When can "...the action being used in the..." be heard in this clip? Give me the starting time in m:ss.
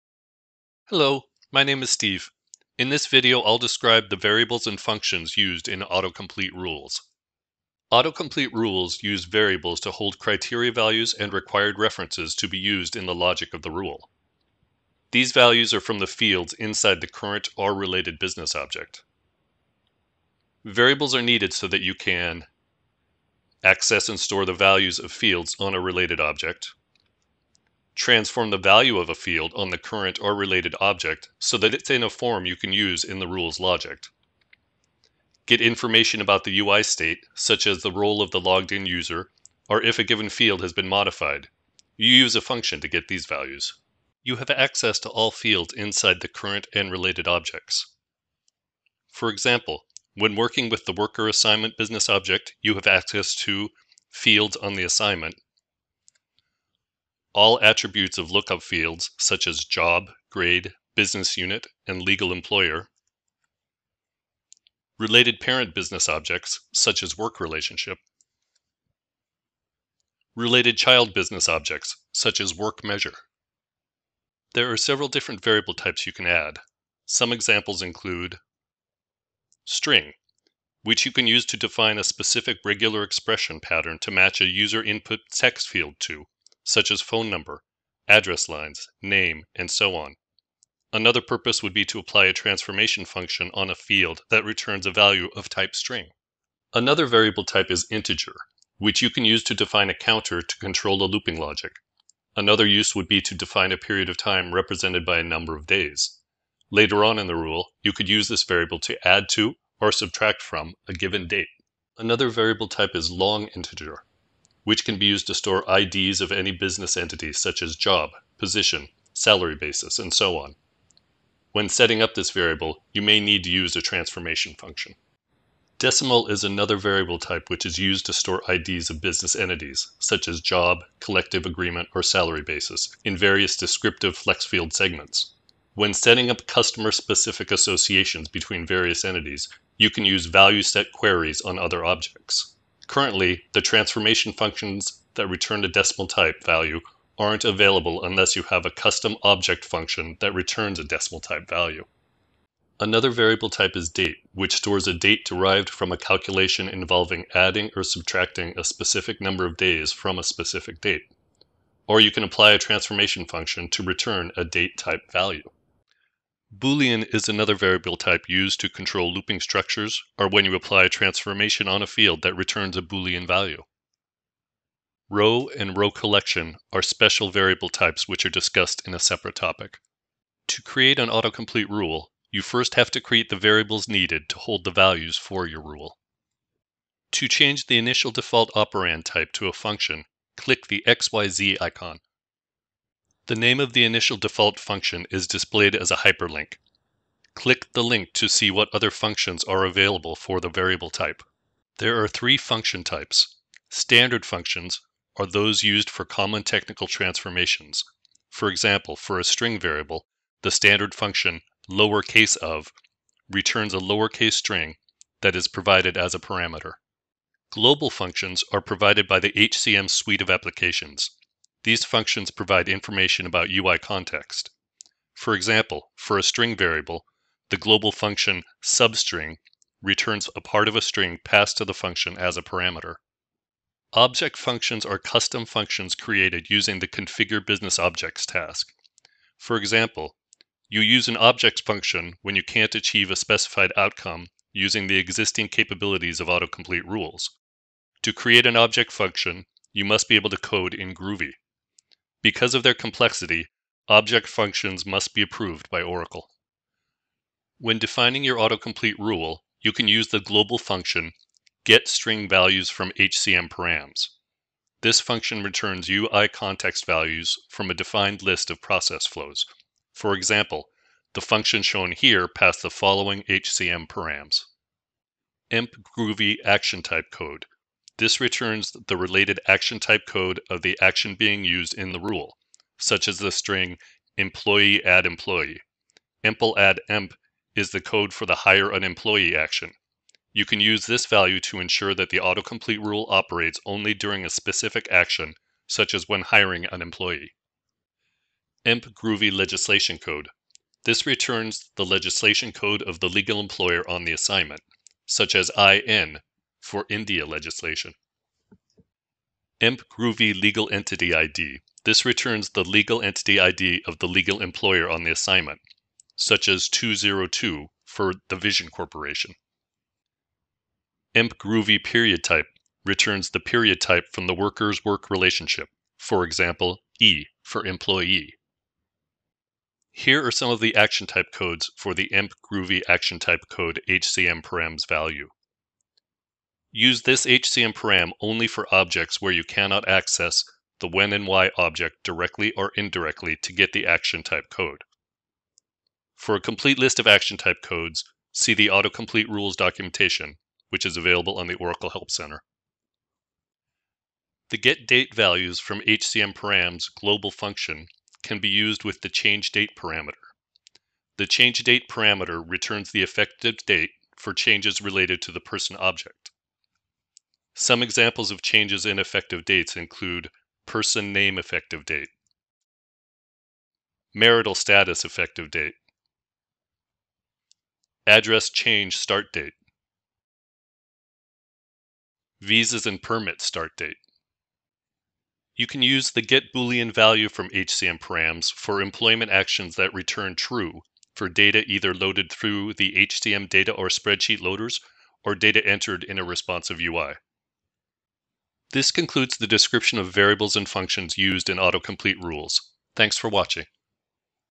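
4:40.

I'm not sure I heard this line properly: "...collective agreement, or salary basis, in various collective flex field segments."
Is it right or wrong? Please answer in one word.
wrong.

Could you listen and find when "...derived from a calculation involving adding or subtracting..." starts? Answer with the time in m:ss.
2:35.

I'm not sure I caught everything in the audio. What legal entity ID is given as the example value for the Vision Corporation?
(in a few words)
202.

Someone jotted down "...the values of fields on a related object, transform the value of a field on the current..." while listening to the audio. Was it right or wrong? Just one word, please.
right.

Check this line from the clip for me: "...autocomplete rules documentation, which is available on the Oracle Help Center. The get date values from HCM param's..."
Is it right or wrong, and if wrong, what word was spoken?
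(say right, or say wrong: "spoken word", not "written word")
right.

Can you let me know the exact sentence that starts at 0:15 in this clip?
These values are from the fields inside the current or related business object.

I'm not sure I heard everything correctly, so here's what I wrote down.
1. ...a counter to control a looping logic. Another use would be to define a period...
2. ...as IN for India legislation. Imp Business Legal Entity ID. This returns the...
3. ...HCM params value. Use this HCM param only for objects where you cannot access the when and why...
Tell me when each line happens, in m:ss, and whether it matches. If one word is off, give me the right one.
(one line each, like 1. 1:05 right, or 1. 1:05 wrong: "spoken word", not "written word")
1. 1:39 right
2. 5:05 wrong: "Groovy", not "Business"
3. 5:33 right.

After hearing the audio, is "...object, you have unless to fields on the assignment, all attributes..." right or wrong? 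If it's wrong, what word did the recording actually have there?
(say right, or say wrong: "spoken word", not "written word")
wrong: "access", not "unless".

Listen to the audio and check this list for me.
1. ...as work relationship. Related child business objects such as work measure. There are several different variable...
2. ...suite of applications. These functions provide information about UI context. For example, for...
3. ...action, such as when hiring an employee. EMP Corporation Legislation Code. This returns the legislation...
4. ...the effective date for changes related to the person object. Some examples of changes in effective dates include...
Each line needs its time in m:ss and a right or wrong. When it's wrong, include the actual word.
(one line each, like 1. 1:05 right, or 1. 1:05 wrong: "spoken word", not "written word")
1. 1:07 right
2. 3:39 right
3. 4:54 wrong: "Groovy", not "Corporation"
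4. 6:02 right.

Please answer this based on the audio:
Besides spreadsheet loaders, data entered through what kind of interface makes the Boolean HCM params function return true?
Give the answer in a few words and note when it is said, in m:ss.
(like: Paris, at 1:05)
responsive UI, at 6:36.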